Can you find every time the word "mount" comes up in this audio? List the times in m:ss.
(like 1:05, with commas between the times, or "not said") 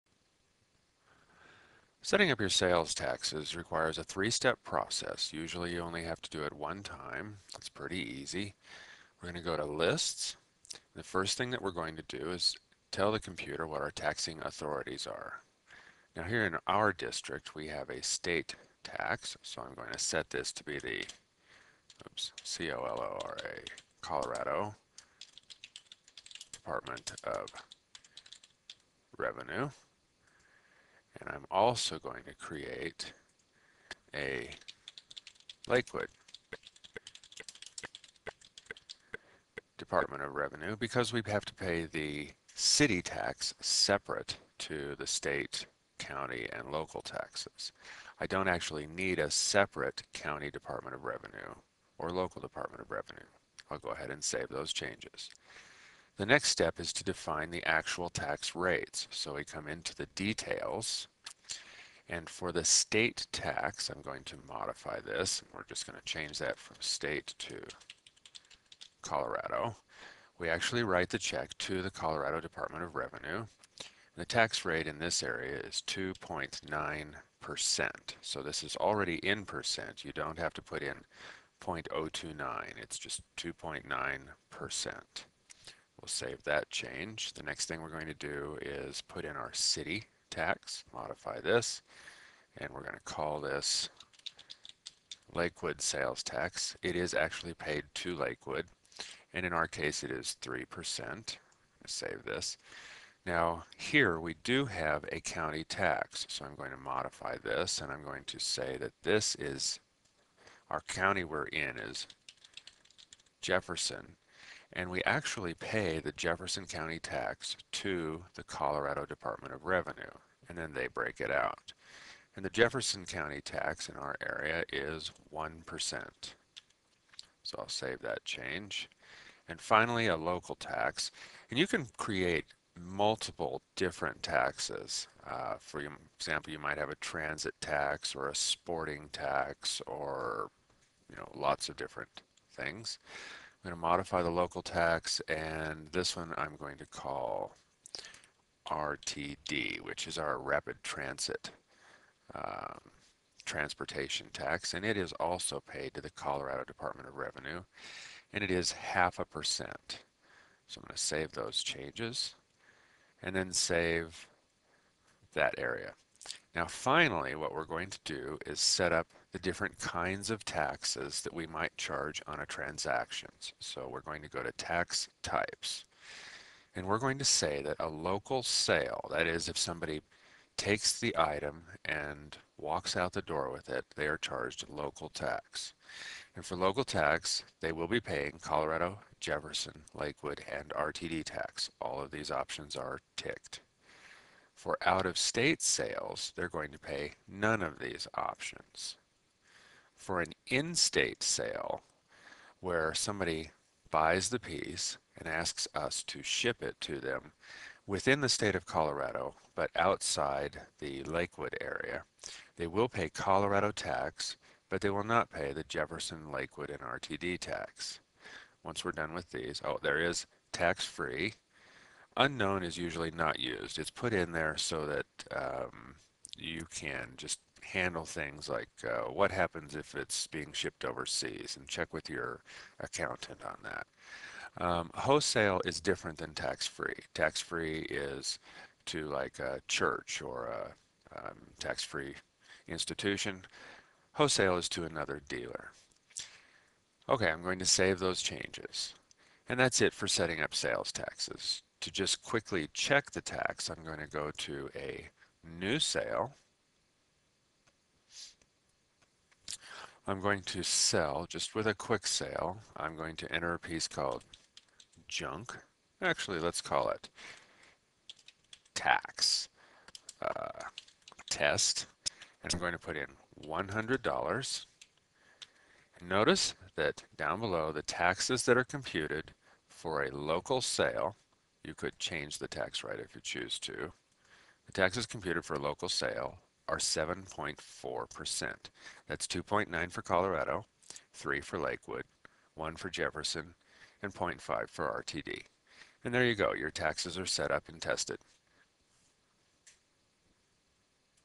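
not said.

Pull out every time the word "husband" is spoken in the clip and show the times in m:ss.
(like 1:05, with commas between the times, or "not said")
not said.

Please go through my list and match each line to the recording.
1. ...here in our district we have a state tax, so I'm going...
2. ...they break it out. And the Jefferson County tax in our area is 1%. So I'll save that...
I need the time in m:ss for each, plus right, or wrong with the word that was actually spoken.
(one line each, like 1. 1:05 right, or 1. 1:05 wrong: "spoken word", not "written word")
1. 0:16 right
2. 2:00 right.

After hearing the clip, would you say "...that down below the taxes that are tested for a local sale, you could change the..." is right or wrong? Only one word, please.
wrong.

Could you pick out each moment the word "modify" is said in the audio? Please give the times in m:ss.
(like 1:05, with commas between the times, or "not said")
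1:04, 1:30, 1:46, 2:23.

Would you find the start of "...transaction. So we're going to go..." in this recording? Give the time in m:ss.
2:52.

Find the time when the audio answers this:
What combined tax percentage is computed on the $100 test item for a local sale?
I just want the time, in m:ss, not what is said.
4:46.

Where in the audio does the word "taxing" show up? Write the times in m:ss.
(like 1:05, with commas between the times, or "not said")
0:13.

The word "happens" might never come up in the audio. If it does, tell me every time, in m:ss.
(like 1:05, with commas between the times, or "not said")
3:49.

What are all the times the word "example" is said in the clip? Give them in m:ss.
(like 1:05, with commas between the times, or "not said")
2:16.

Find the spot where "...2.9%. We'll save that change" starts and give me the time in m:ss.
1:23.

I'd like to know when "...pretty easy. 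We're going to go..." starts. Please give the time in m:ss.
0:07.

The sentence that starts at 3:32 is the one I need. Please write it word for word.
They will pay Colorado tax, but they will not pay the Jefferson, Lakewood, and RTD tax.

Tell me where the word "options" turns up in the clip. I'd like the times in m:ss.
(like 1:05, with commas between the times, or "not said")
3:12, 3:18.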